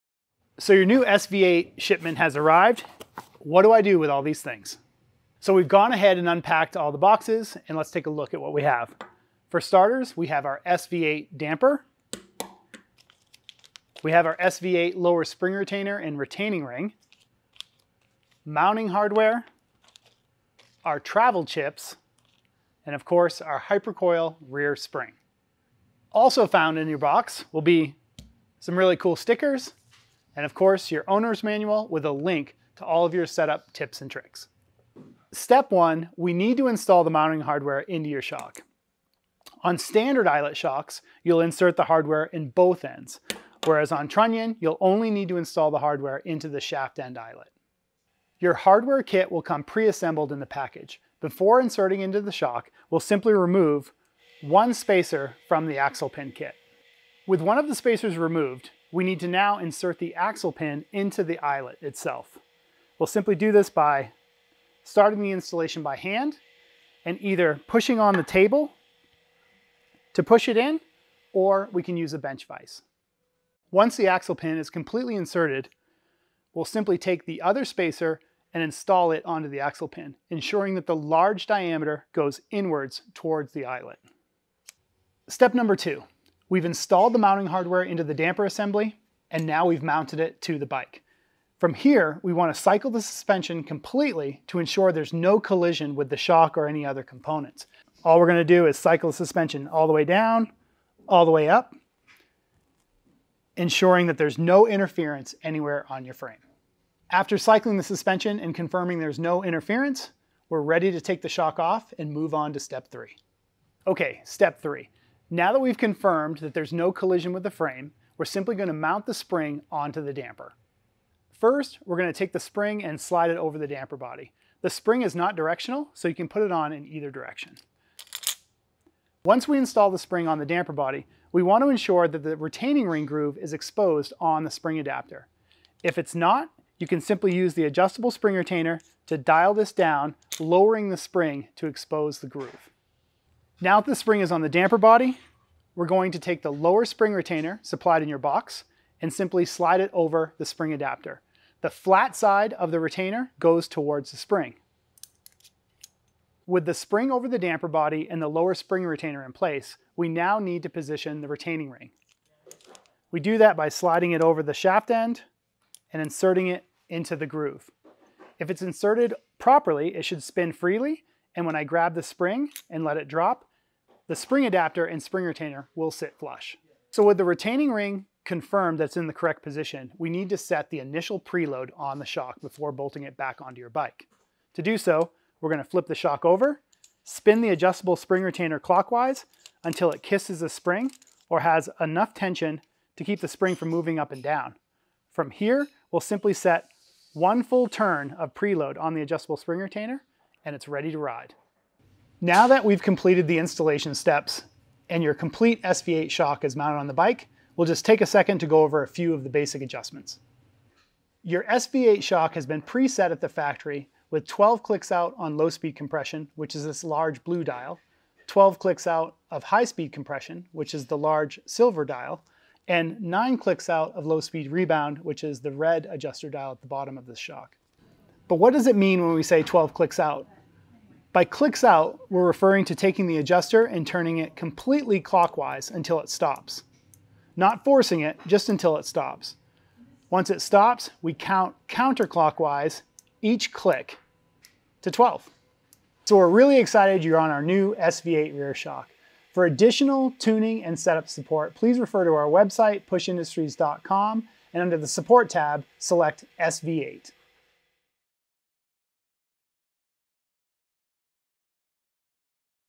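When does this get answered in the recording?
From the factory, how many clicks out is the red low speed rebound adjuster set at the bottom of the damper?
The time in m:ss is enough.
3:43.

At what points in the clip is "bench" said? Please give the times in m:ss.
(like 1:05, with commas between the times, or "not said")
1:12.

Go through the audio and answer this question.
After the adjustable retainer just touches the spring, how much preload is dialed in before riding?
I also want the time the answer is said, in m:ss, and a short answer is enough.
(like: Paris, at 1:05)
1 full turn, at 3:17.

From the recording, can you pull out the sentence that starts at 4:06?
So we're really excited you're on our new SV8 rear shock.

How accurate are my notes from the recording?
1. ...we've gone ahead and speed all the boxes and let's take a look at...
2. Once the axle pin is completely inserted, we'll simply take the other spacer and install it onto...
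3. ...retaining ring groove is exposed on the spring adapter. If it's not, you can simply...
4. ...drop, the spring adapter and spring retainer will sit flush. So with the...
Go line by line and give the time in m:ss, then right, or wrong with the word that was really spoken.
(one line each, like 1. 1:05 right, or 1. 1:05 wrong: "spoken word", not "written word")
1. 0:05 wrong: "unpacked", not "speed"
2. 1:13 right
3. 2:12 right
4. 2:53 right.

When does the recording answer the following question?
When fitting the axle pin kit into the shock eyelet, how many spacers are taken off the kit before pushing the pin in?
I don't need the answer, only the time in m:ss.
0:53.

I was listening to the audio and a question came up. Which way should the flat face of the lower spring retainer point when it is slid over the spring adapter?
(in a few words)
Towards the spring.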